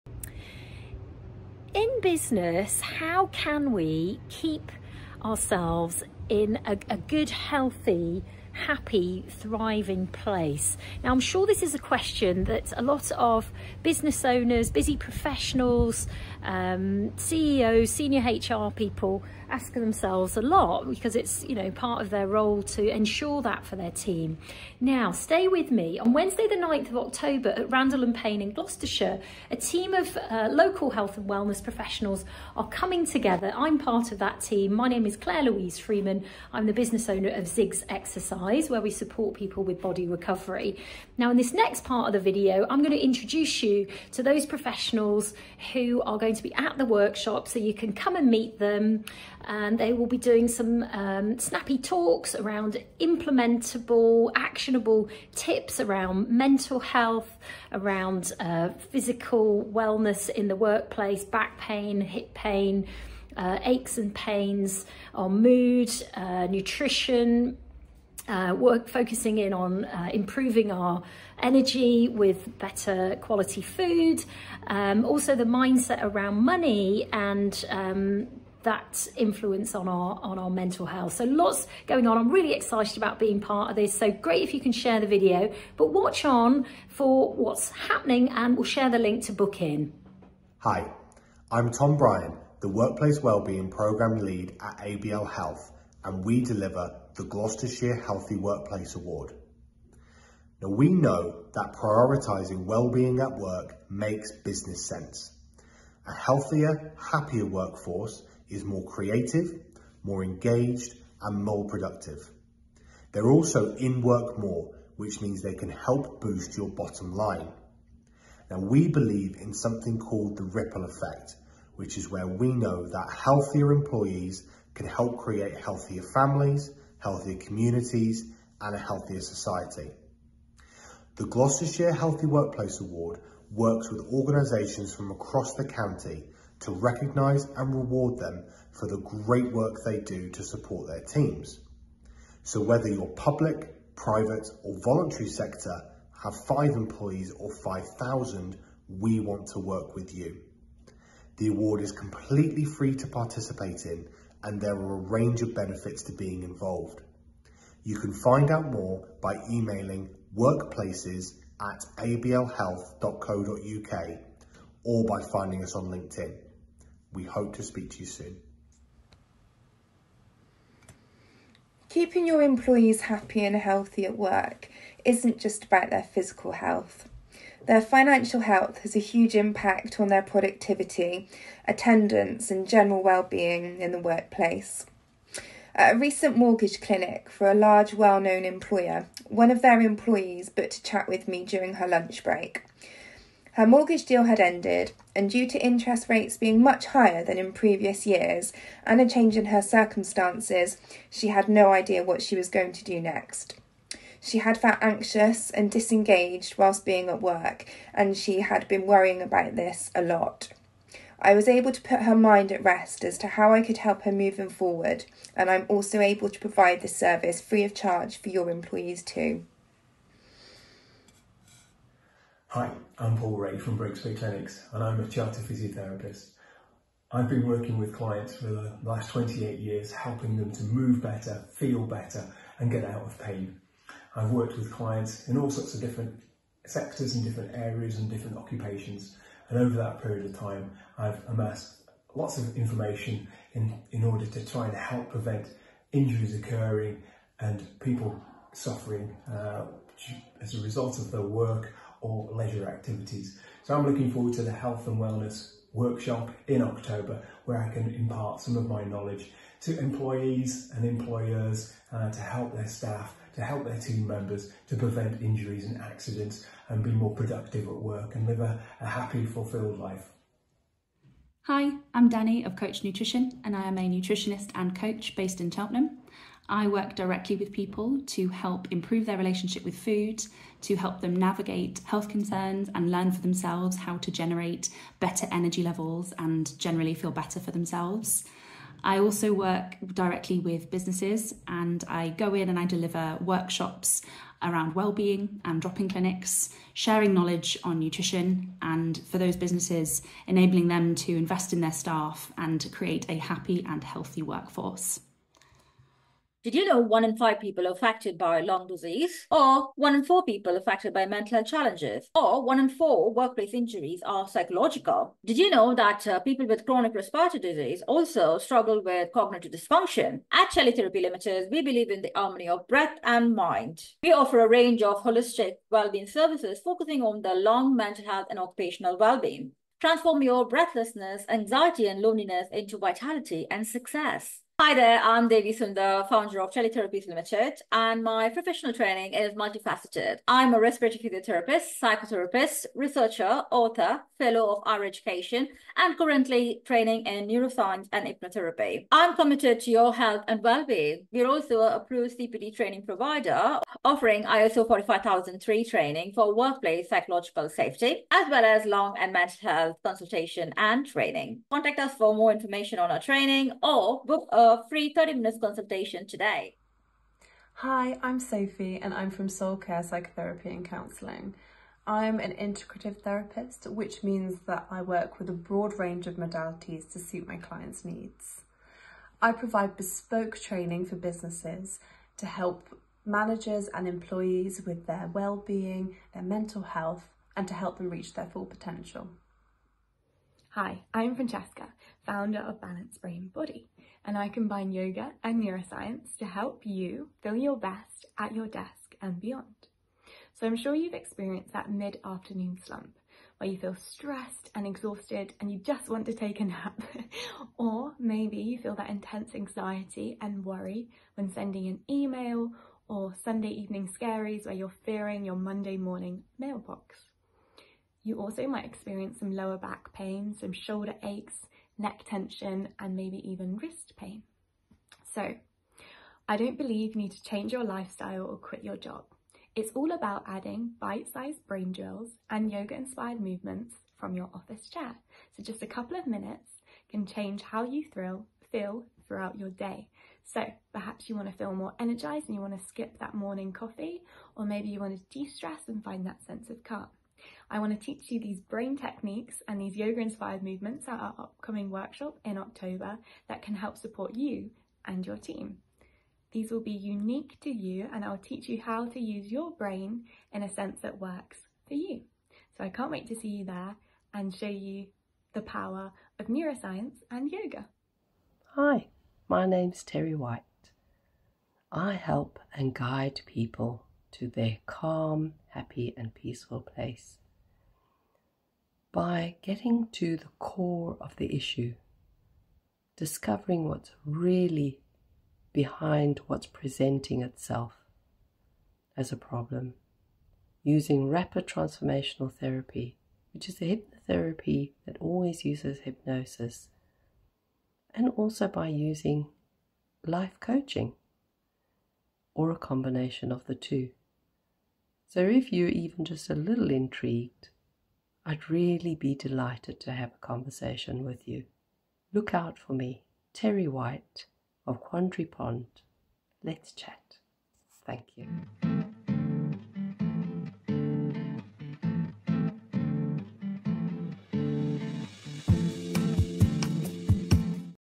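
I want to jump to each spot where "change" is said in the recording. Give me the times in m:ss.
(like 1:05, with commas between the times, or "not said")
3:19, 7:07, 7:17.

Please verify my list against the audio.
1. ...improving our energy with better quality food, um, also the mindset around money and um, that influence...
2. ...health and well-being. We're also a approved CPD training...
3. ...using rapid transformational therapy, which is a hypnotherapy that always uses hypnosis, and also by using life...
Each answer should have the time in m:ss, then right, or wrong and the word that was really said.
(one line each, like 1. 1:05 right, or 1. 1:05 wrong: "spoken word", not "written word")
1. 1:10 right
2. 5:49 right
3. 8:10 right.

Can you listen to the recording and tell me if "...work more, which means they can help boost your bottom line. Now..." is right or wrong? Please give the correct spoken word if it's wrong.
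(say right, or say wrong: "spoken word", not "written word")
right.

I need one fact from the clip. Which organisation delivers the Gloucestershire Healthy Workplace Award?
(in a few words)
ABL Health.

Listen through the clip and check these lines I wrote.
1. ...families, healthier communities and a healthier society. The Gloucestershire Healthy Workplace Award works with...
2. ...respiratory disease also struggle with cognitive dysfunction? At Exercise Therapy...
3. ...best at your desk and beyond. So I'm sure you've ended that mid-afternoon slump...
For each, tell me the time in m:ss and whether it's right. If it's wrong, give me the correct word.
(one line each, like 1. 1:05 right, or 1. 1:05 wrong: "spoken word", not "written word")
1. 2:06 right
2. 5:16 wrong: "Shelley", not "Exercise"
3. 6:37 wrong: "experienced", not "ended".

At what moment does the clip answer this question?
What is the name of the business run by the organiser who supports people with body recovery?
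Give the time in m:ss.
0:37.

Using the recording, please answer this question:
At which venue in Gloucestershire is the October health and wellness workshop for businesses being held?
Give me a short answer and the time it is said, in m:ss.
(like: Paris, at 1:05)
Randall and Payne, at 0:27.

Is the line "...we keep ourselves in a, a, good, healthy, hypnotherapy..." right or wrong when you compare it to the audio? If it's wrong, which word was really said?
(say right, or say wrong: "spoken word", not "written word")
wrong: "happy", not "hypnotherapy".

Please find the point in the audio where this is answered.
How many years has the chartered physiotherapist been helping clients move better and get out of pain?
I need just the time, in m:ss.
3:49.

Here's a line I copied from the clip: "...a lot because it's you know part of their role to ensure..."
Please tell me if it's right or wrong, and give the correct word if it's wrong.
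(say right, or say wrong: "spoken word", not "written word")
right.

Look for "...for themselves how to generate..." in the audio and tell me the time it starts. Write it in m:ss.
4:43.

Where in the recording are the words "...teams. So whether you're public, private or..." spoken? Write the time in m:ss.
2:21.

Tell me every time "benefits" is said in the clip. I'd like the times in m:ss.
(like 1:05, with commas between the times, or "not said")
2:35.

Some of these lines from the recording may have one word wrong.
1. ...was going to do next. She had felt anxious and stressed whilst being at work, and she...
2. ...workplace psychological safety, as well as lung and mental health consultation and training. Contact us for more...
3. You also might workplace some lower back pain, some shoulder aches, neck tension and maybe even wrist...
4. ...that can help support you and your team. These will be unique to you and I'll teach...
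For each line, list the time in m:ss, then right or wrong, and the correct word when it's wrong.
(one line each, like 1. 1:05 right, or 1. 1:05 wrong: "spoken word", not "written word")
1. 3:22 wrong: "disengaged", not "stressed"
2. 5:56 right
3. 6:58 wrong: "experience", not "workplace"
4. 7:33 right.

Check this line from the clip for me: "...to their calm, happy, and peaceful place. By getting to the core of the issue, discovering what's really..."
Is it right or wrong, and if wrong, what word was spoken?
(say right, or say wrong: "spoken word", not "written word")
right.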